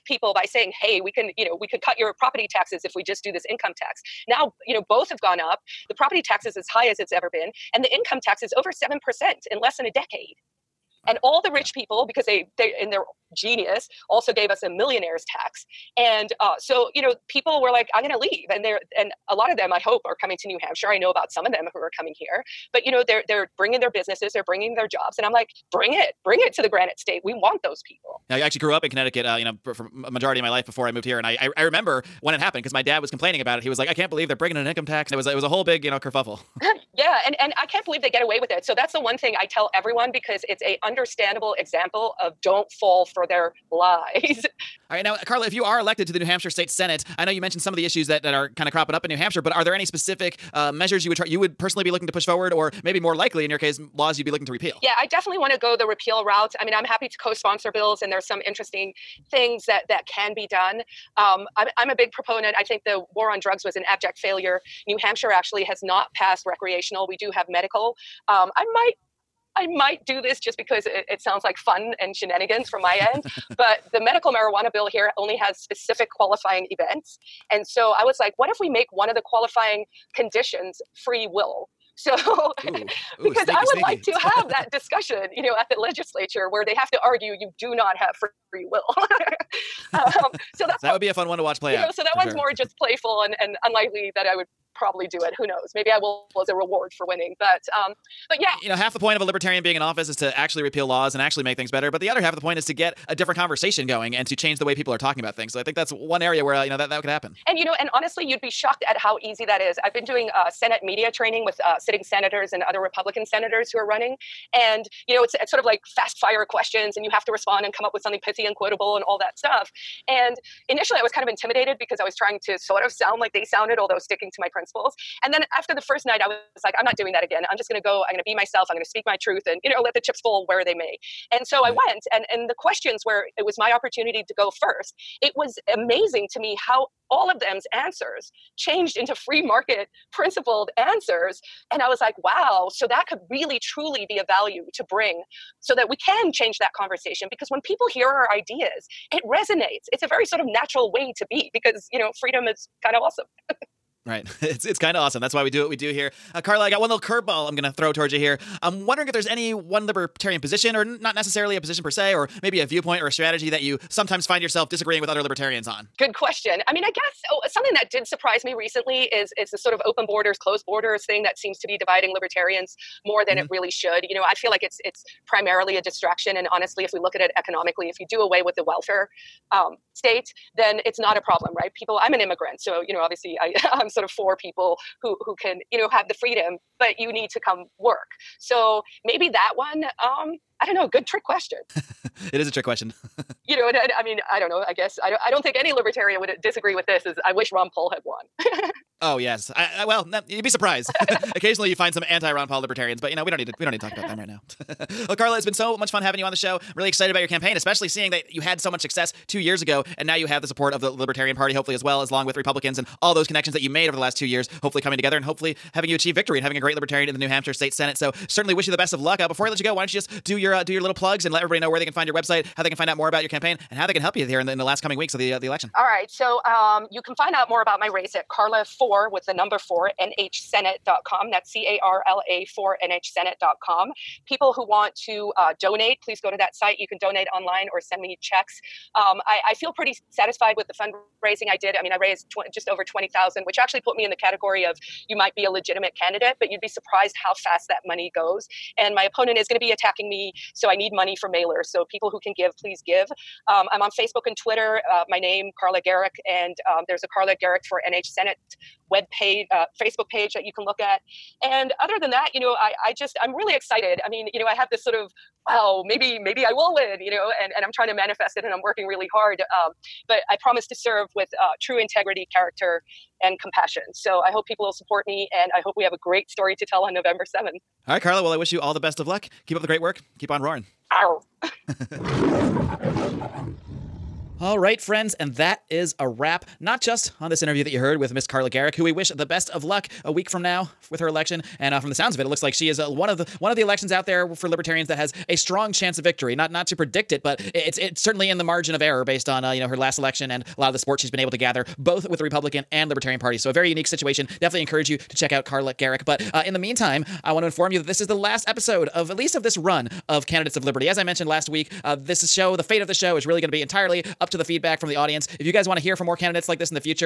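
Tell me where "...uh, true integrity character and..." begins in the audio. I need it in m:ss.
4:31.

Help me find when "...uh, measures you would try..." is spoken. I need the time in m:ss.
0:50.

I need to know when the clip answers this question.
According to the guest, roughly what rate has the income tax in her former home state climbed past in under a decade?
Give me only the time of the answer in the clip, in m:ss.
0:08.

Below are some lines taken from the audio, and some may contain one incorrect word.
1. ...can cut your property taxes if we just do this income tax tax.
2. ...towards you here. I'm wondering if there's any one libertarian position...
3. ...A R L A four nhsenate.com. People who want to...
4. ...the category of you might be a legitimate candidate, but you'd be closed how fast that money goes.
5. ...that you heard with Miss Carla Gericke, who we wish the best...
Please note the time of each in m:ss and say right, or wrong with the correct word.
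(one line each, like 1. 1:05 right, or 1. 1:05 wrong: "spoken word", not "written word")
1. 0:01 right
2. 2:37 right
3. 3:51 right
4. 4:04 wrong: "surprised", not "closed"
5. 4:47 right.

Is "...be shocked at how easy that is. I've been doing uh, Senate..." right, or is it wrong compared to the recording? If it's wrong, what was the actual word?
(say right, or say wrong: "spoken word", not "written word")
right.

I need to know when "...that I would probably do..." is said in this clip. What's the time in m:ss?
1:34.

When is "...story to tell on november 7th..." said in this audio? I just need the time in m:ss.
4:36.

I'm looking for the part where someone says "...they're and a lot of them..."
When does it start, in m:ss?
0:18.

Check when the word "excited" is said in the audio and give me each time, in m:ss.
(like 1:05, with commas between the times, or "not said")
3:26, 4:23.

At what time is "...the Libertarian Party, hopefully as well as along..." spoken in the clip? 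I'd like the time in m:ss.
3:30.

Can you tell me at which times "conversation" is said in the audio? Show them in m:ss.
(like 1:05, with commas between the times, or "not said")
1:43, 2:26.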